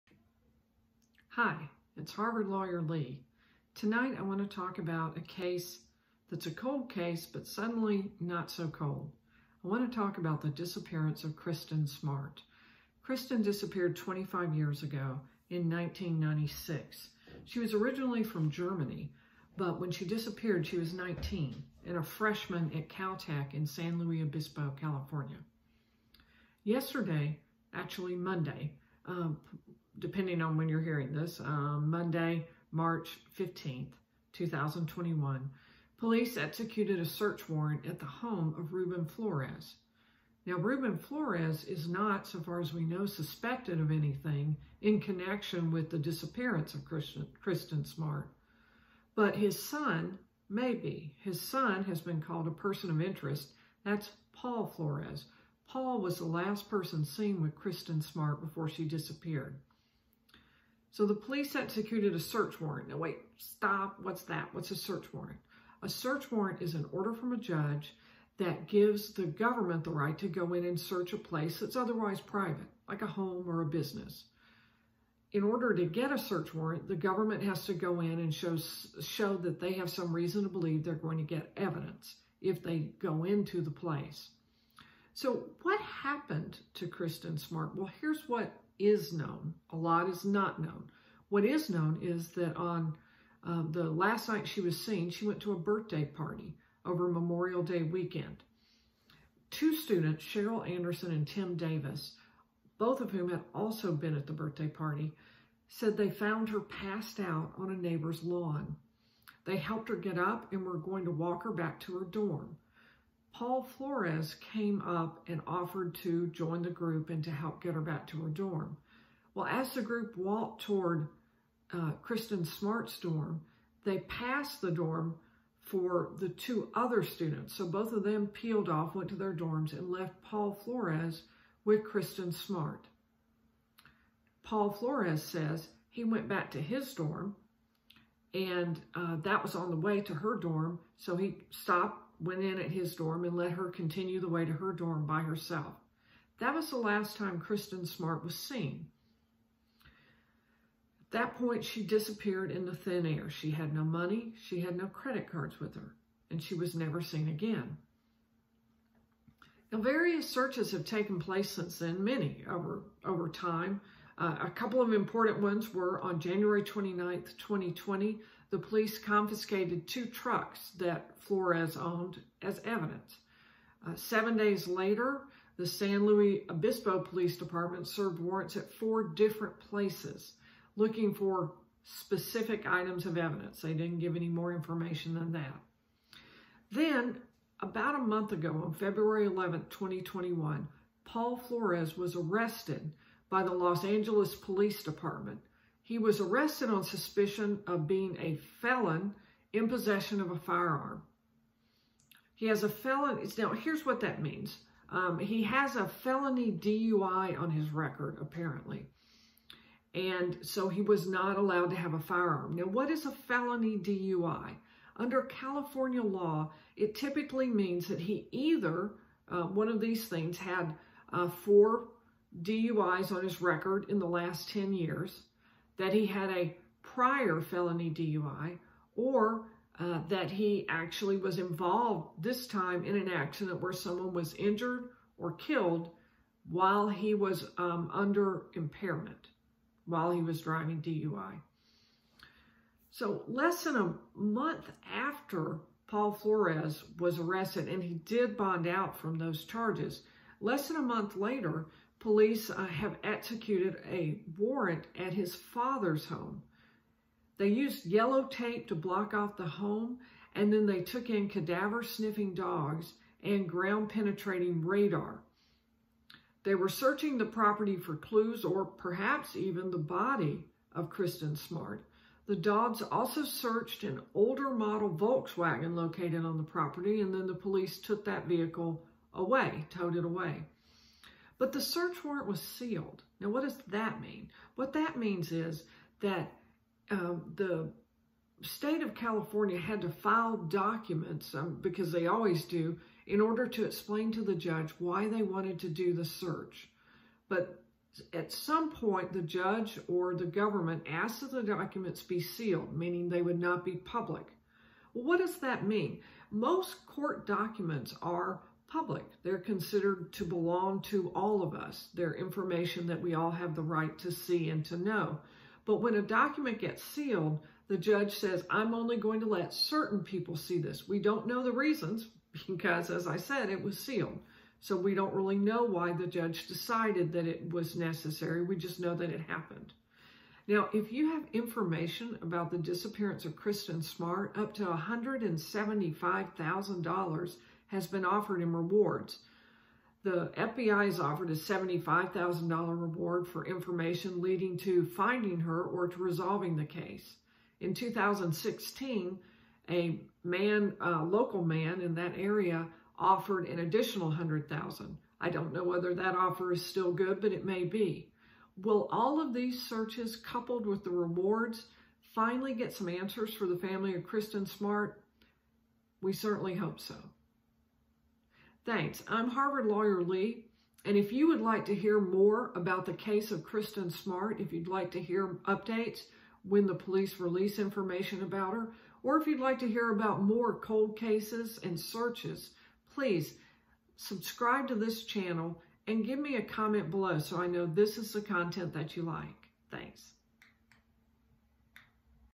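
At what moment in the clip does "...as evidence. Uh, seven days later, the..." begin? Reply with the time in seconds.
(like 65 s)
172 s.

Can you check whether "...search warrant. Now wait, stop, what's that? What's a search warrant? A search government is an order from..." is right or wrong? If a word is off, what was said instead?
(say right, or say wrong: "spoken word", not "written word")
wrong: "warrant", not "government".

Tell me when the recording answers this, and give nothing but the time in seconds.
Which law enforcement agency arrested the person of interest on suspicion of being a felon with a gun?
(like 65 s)
193 s.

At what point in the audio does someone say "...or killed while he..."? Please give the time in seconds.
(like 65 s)
235 s.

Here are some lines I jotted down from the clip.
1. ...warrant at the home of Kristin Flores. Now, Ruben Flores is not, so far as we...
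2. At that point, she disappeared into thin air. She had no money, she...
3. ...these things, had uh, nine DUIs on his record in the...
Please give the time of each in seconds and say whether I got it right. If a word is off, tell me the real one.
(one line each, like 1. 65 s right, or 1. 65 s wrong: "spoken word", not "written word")
1. 37 s wrong: "Ruben", not "Kristin"
2. 151 s right
3. 219 s wrong: "four", not "nine".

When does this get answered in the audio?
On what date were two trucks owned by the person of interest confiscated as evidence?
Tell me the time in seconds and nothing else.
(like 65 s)
166 s.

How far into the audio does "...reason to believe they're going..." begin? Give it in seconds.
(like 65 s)
80 s.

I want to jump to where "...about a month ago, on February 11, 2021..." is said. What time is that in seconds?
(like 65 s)
187 s.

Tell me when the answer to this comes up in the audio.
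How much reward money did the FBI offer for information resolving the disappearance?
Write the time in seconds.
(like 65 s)
341 s.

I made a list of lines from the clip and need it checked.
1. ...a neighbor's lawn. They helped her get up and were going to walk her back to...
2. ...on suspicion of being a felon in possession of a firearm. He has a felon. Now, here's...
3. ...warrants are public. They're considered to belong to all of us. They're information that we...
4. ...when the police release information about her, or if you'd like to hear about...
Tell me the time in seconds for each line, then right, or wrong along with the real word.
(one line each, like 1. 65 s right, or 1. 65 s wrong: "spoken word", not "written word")
1. 107 s right
2. 196 s right
3. 307 s wrong: "documents", not "warrants"
4. 376 s right.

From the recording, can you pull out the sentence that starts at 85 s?
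So what happened to Kristin Smart?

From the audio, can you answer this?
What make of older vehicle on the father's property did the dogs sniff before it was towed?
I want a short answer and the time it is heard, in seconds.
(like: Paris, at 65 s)
Volkswagen, at 274 s.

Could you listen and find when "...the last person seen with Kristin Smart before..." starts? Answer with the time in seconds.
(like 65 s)
56 s.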